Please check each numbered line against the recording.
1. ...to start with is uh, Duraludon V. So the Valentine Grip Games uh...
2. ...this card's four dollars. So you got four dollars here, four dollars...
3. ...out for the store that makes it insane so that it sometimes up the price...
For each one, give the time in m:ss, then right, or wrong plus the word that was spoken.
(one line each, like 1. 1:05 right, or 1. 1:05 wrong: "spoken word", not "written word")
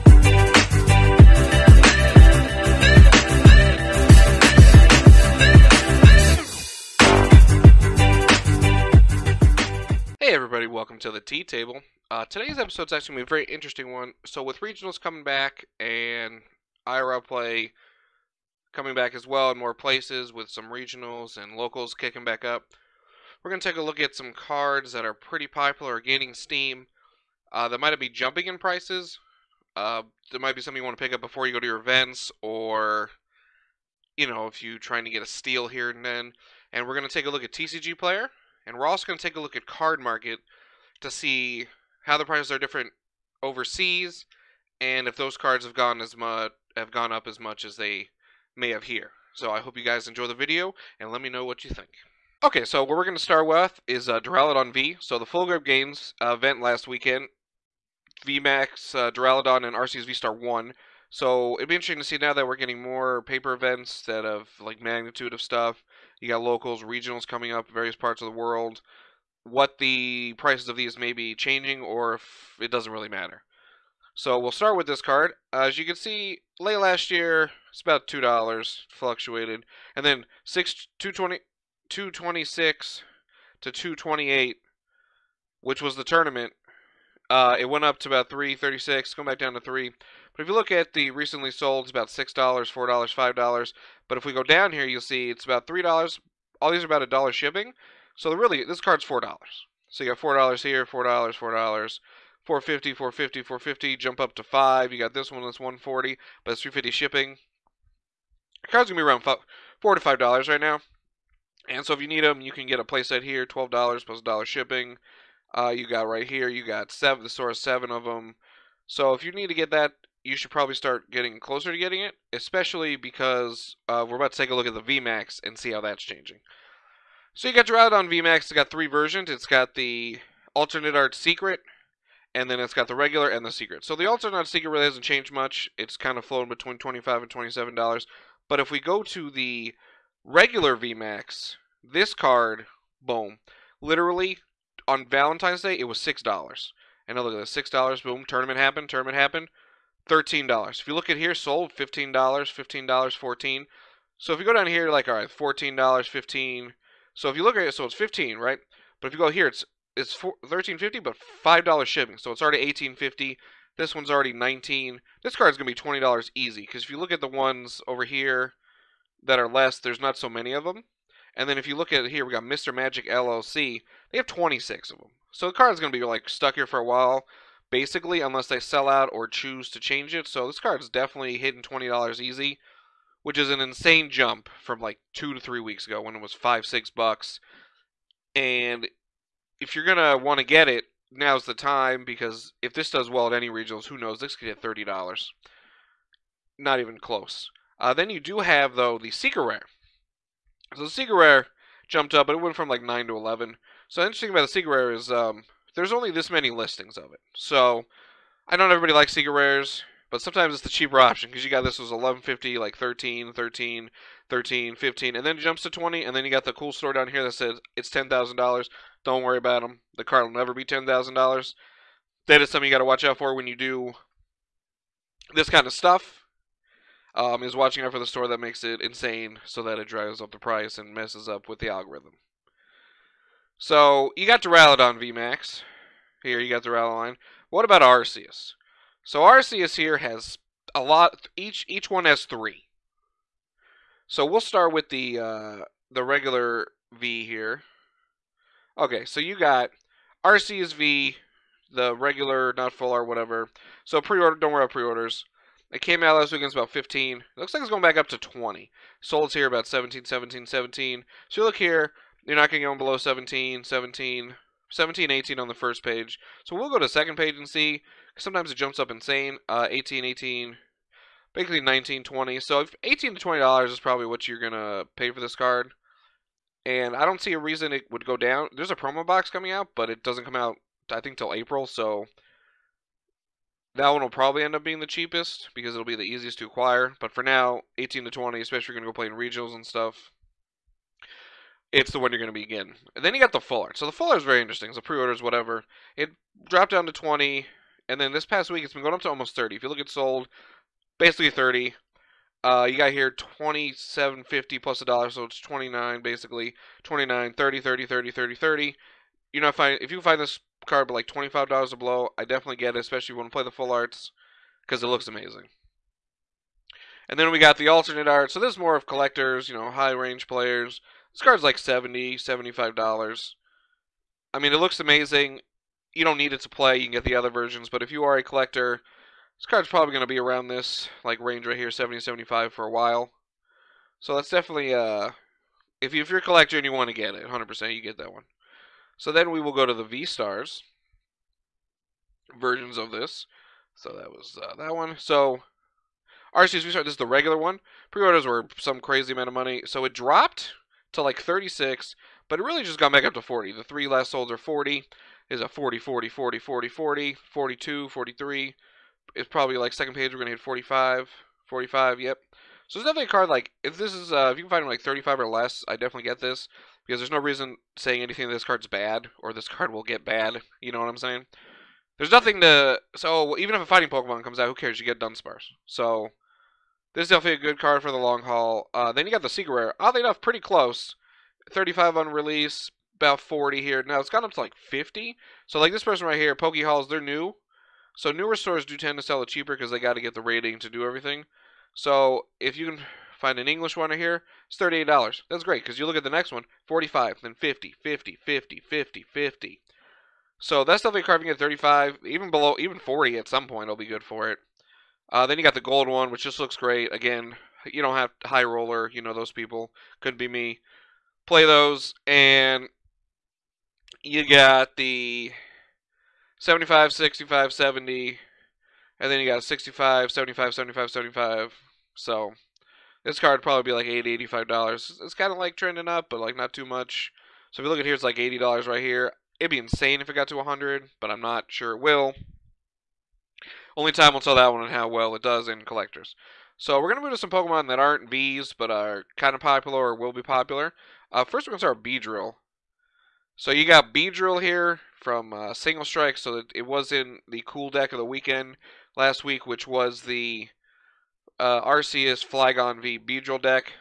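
1. 0:53 wrong: "Full", not "Valentine"
2. 1:38 right
3. 3:47 wrong: "drives", not "sometimes".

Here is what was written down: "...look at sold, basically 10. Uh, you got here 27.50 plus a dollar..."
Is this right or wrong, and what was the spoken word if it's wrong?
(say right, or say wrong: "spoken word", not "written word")
wrong: "30", not "10".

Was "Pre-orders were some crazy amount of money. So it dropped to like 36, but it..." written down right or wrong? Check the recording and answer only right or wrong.
right.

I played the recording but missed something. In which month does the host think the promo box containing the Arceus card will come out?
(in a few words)
April.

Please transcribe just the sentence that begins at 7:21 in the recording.
Uh, first, we're going to start Beedrill.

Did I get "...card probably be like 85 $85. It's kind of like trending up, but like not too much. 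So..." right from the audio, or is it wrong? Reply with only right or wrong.
wrong.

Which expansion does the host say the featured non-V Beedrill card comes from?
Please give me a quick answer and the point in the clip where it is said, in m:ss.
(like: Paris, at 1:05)
Single Strike, at 7:25.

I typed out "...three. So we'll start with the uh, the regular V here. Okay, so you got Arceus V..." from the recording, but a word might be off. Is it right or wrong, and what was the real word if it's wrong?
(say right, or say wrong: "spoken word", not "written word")
right.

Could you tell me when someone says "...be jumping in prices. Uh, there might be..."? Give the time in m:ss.
0:27.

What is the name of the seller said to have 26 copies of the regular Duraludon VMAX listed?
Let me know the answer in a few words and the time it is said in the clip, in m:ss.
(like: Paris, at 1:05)
Mr. Magic LLC, at 2:52.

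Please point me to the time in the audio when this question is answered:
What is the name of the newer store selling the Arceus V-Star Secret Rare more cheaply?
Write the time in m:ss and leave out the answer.
6:26.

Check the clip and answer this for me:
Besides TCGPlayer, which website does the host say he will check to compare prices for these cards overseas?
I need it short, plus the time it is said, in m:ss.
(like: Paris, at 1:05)
Cardmarket, at 0:39.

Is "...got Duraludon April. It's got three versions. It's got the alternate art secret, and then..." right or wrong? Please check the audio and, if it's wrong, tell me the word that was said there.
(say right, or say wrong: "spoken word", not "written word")
wrong: "VMAX", not "April".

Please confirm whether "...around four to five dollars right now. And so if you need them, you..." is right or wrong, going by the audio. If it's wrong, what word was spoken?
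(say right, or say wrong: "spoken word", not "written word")
right.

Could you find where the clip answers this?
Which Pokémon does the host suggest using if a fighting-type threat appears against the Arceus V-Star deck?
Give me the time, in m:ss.
6:14.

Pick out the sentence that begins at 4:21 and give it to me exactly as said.
So you look here, you're not going to go below 17, 17, 17, 18 on the first page.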